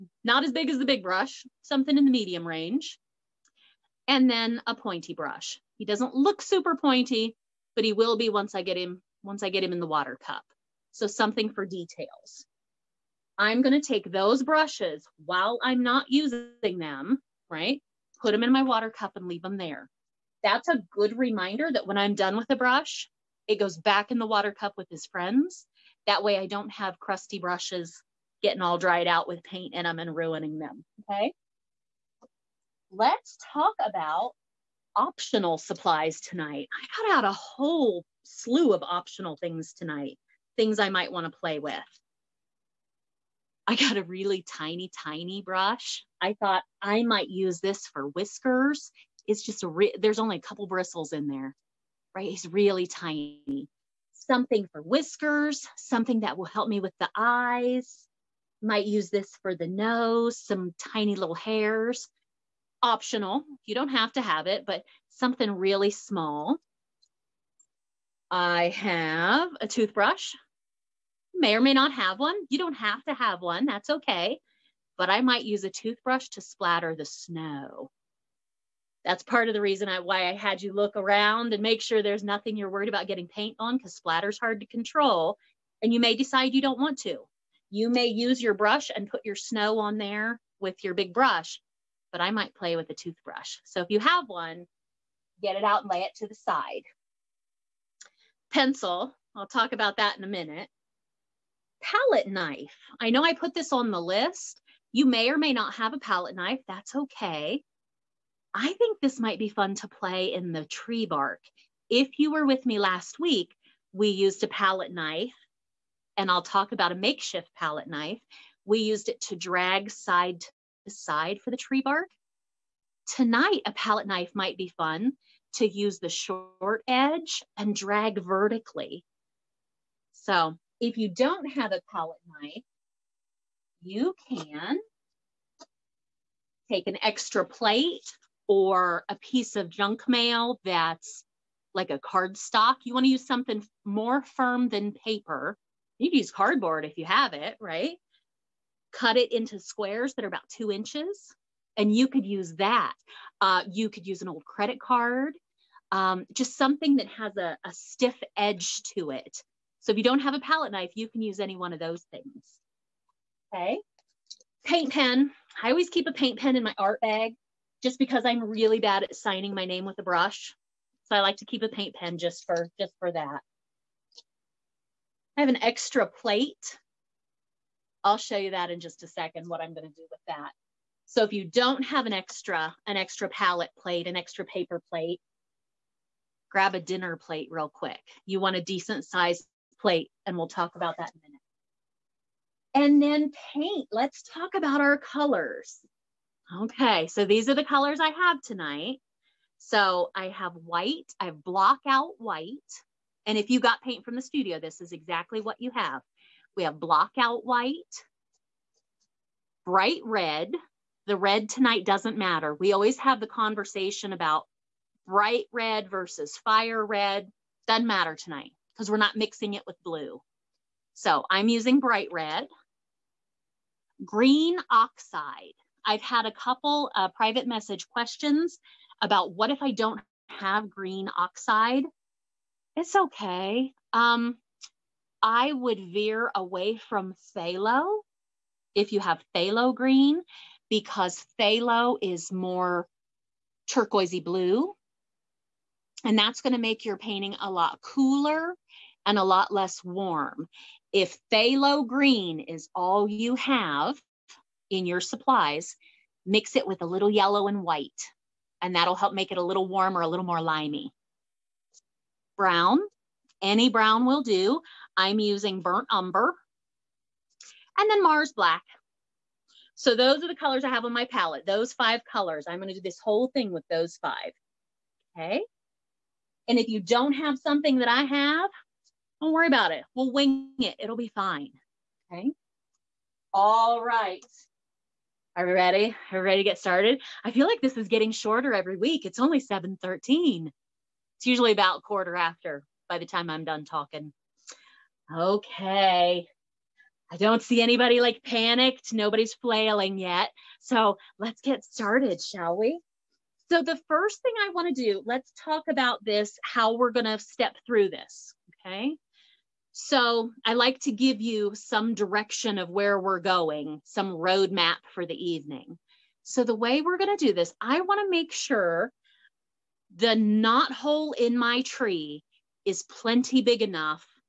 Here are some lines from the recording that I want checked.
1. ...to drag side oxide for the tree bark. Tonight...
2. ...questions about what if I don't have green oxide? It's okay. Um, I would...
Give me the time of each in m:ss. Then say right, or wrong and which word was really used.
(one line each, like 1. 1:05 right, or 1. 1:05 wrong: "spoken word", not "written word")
1. 1:59 wrong: "aside", not "oxide"
2. 3:47 right.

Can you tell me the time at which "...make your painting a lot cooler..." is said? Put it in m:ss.
4:06.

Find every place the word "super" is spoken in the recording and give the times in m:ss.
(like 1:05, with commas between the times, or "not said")
0:06.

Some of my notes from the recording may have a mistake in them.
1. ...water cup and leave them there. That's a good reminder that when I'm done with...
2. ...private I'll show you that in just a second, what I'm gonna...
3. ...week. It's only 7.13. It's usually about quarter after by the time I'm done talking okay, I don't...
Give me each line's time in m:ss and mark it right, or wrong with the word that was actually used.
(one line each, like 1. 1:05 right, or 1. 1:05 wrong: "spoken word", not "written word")
1. 0:18 right
2. 2:56 wrong: "plate", not "private"
3. 4:48 right.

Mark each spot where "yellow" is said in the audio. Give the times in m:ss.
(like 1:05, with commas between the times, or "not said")
4:17.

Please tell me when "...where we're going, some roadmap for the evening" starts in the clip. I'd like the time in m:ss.
5:12.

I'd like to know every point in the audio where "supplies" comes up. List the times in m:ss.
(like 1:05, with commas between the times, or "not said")
0:35, 4:15.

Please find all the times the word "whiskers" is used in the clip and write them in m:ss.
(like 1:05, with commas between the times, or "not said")
0:48, 0:54.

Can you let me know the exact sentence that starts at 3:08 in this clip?
You want a decent sized plate and we'll talk about that in a minute.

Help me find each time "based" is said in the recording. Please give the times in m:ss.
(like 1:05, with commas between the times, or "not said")
not said.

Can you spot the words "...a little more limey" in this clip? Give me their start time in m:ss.
4:20.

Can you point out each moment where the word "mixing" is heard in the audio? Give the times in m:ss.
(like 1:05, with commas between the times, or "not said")
3:39.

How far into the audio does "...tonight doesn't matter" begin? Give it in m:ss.
3:31.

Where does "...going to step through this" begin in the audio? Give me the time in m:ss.
5:06.